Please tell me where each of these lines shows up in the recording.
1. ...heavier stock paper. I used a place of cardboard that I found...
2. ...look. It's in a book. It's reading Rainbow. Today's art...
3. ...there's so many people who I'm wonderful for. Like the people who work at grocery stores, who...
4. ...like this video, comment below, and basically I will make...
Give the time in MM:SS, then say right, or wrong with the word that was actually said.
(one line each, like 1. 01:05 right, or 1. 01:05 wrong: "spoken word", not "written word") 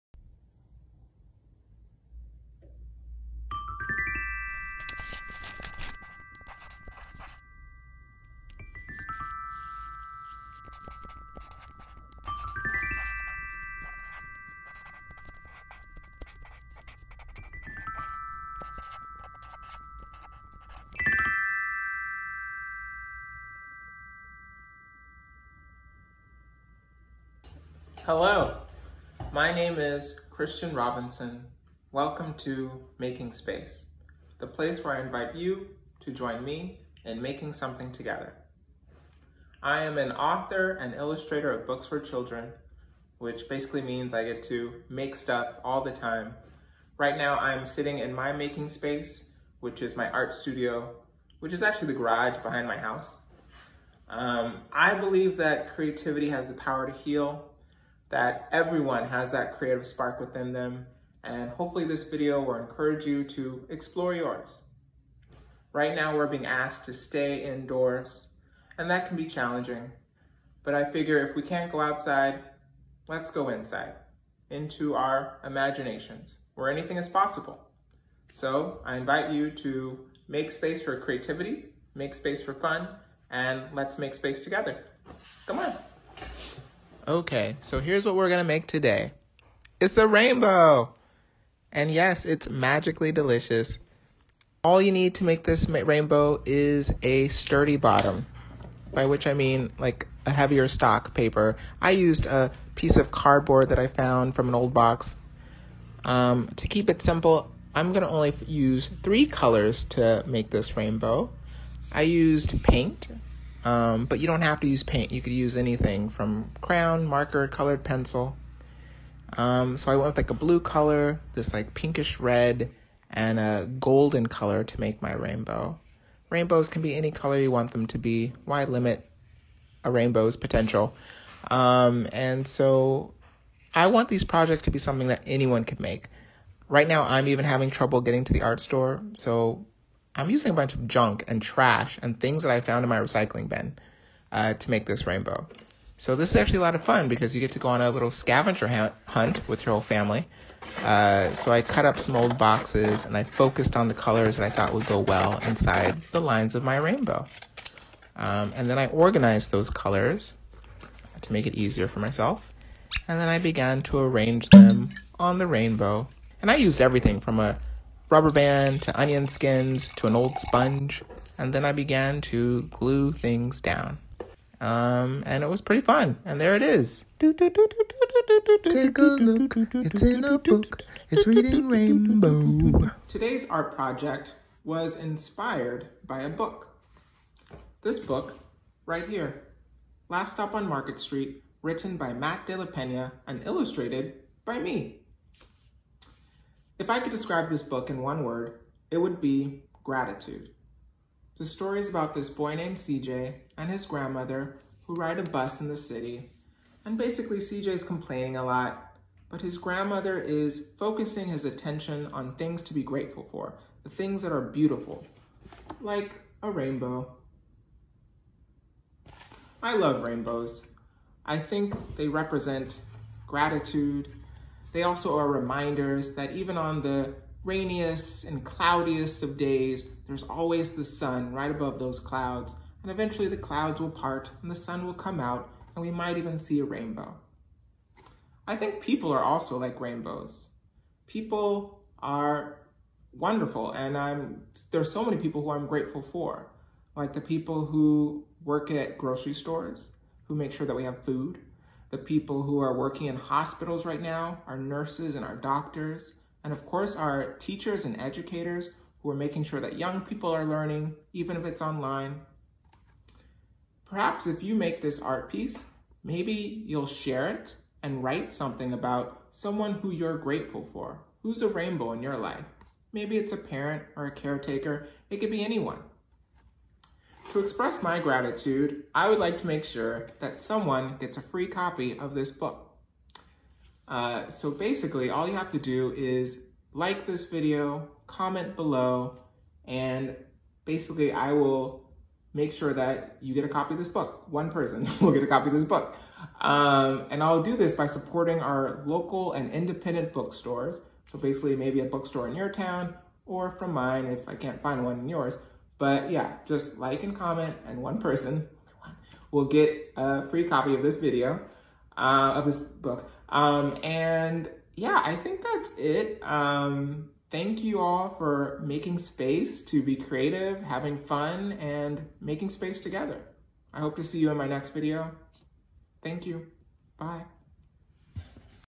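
1. 01:40 wrong: "piece", not "place"
2. 02:57 right
3. 04:04 wrong: "grateful", not "wonderful"
4. 04:46 right.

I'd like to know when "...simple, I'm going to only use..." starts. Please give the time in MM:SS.
01:47.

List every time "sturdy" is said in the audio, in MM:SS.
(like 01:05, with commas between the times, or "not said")
01:37.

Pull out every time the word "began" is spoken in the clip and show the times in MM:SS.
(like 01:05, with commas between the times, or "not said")
02:43, 02:51.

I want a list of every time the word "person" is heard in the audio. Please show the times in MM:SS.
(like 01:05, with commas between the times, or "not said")
04:54, 05:07.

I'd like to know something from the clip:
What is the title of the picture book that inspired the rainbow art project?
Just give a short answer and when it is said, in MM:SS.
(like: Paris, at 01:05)
Last Stop on Market Street, at 03:10.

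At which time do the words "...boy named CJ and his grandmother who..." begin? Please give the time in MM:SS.
03:22.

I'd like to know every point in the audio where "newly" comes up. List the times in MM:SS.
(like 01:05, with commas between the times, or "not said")
not said.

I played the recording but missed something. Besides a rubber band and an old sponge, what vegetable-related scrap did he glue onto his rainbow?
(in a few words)
Onion skins.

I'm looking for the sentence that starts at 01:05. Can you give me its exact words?
Right now we're being asked to stay indoors, and that can be challenging.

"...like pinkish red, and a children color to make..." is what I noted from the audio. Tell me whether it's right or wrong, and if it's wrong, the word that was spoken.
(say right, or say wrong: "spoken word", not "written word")
wrong: "golden", not "children".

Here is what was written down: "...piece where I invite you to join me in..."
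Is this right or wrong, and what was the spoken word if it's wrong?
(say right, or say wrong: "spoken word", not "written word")
wrong: "place", not "piece".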